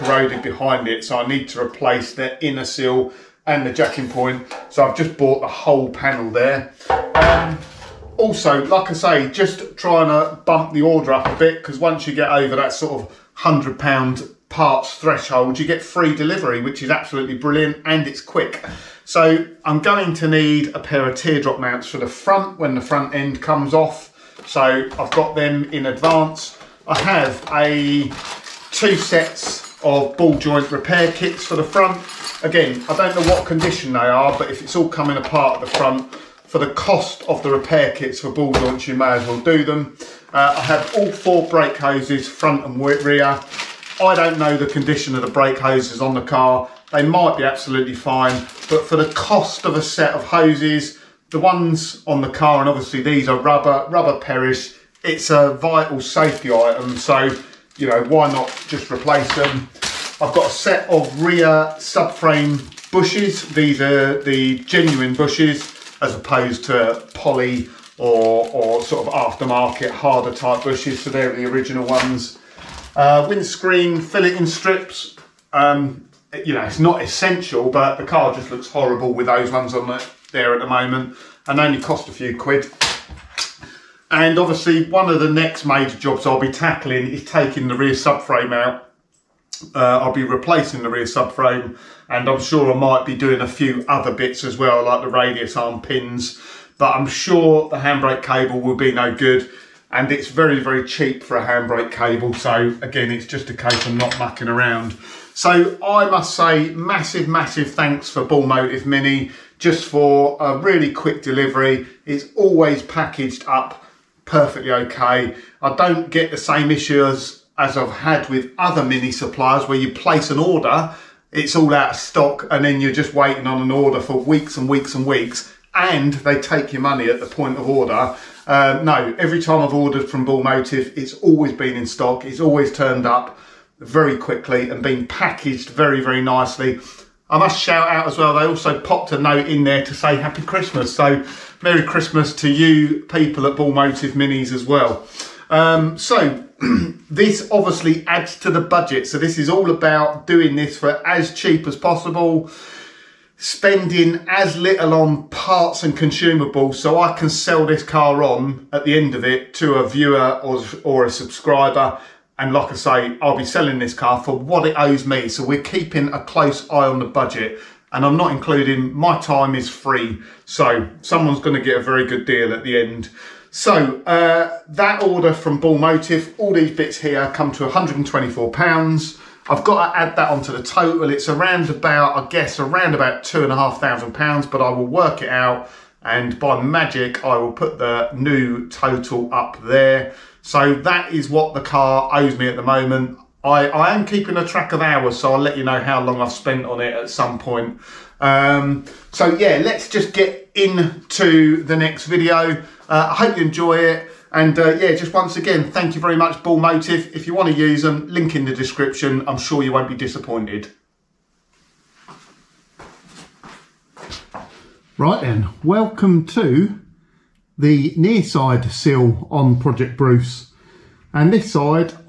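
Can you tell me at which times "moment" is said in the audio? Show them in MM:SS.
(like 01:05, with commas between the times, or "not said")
01:20, 03:12.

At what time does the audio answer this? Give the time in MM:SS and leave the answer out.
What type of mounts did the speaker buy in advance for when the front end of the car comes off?
00:21.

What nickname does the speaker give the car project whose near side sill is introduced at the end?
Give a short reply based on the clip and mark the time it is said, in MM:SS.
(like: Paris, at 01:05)
Project Bruce, at 03:39.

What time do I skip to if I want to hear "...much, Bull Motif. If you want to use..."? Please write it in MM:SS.
03:26.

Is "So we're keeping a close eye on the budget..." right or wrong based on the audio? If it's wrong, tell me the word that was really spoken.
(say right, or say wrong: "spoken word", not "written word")
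right.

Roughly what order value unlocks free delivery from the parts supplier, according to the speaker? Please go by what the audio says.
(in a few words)
£100.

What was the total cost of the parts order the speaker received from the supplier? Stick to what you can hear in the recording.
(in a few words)
£124.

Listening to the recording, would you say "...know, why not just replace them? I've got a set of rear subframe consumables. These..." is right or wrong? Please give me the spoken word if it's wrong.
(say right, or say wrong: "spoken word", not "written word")
wrong: "bushes", not "consumables".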